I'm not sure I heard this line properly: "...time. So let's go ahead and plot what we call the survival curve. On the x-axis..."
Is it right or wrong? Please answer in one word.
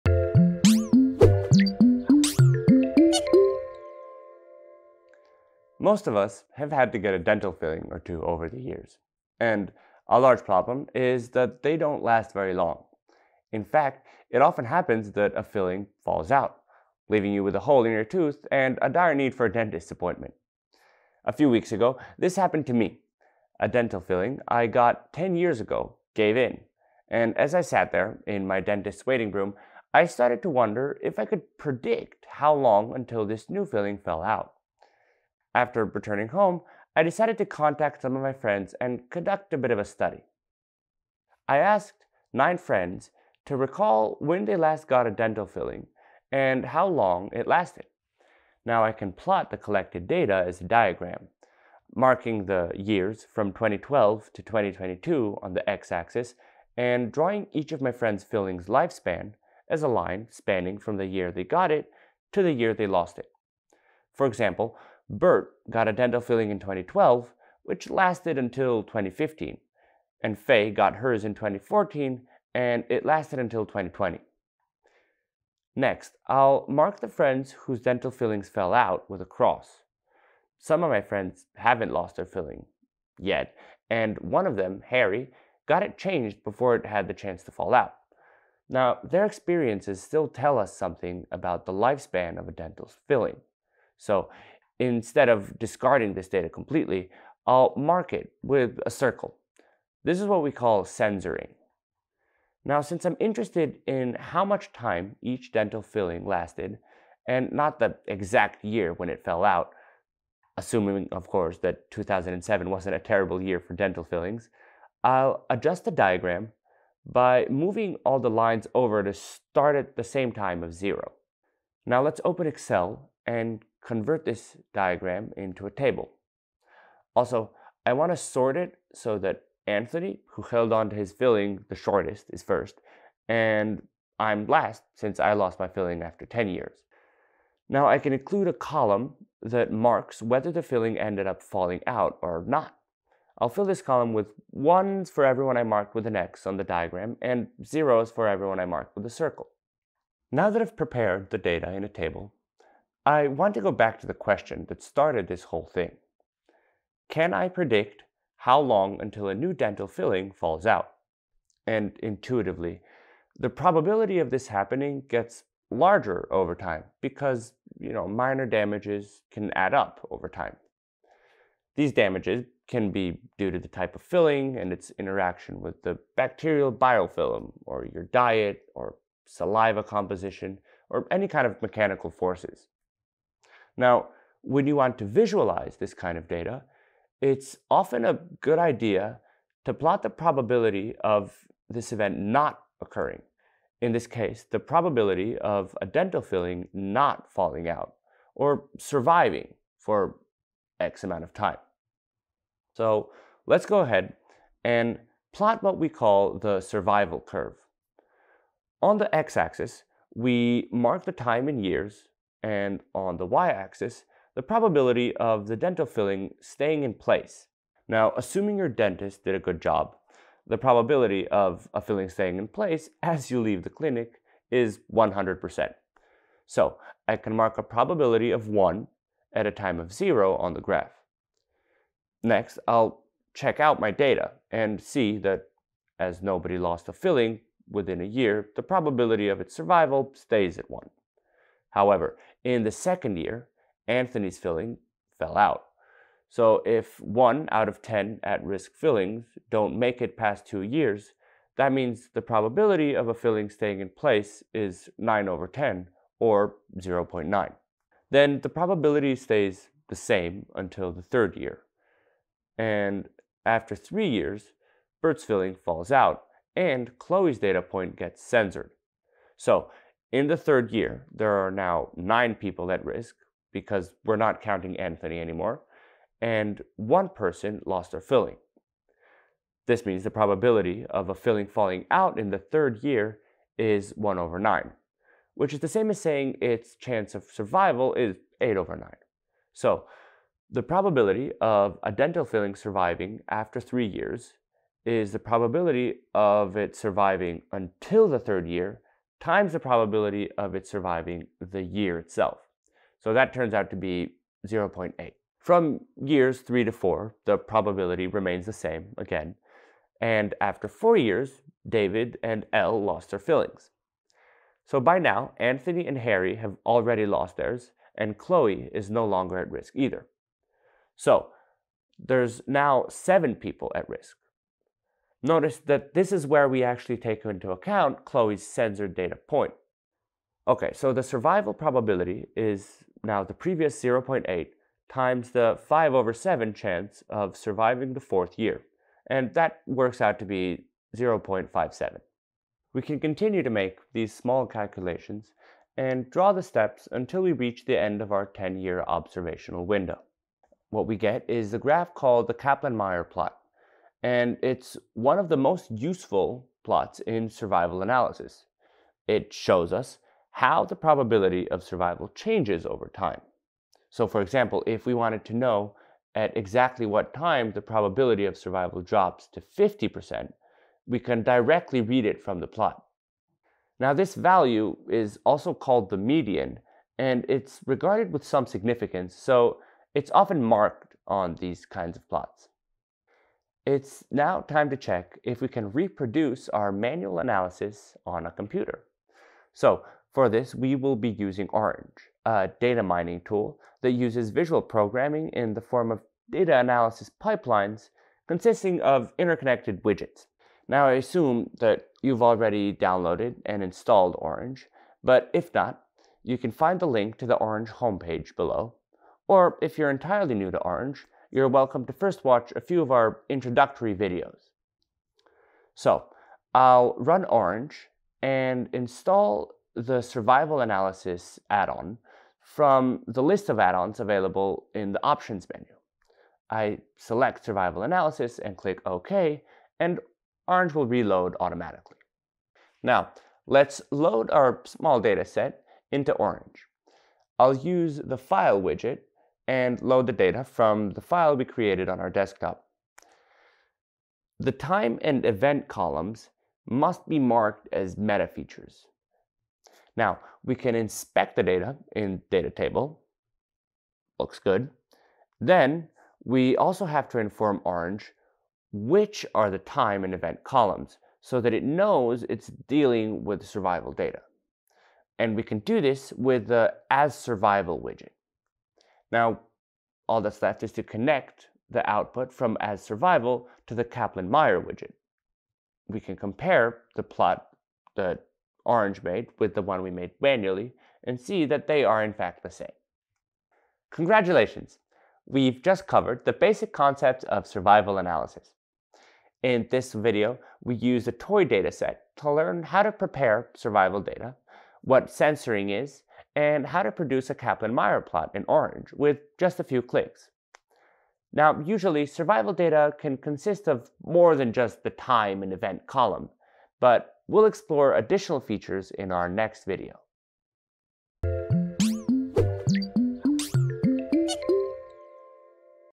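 right.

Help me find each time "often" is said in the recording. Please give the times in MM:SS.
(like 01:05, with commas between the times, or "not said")
00:14, 03:07, 06:20.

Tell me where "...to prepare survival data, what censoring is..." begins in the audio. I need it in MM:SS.
08:12.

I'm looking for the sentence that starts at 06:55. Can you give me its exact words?
So I'll run Orange and install the survival analysis add-on from the list of add-ons available in the options menu.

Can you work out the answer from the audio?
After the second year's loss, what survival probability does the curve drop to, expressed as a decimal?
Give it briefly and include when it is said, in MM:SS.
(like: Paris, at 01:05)
0.9, at 04:16.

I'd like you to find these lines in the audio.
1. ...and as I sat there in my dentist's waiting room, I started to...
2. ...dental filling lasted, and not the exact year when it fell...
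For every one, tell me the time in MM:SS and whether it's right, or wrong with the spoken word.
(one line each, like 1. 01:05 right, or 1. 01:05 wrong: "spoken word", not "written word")
1. 00:27 right
2. 01:45 right.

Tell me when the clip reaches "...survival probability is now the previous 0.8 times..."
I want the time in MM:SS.
05:31.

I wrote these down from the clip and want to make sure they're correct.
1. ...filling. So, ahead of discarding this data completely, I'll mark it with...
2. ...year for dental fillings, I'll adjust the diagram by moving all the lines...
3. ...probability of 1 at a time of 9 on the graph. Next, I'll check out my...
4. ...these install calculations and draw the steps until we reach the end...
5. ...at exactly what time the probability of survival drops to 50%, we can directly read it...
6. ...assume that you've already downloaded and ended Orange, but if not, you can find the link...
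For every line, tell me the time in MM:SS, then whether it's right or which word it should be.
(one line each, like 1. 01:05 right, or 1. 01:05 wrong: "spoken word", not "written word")
1. 01:33 wrong: "instead", not "ahead"
2. 01:53 right
3. 03:47 wrong: "0", not "9"
4. 05:43 wrong: "small", not "install"
5. 06:06 right
6. 06:40 wrong: "installed", not "ended".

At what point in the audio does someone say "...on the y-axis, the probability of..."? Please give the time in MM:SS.
03:32.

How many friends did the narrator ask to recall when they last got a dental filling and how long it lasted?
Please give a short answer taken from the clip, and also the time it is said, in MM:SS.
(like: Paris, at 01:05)
9, at 00:42.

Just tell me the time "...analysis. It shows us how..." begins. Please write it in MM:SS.
05:57.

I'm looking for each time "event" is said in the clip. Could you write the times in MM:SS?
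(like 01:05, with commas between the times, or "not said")
03:11, 07:25, 07:40, 08:25.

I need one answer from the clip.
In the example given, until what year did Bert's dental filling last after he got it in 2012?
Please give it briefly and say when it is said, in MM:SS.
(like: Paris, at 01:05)
2015, at 01:08.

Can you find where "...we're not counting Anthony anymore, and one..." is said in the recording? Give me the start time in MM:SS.
04:34.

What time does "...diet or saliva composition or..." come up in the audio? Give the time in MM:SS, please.
02:58.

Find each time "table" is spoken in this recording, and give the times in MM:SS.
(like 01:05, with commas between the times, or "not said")
02:05, 02:31, 07:32.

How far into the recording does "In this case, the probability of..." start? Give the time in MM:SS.
03:13.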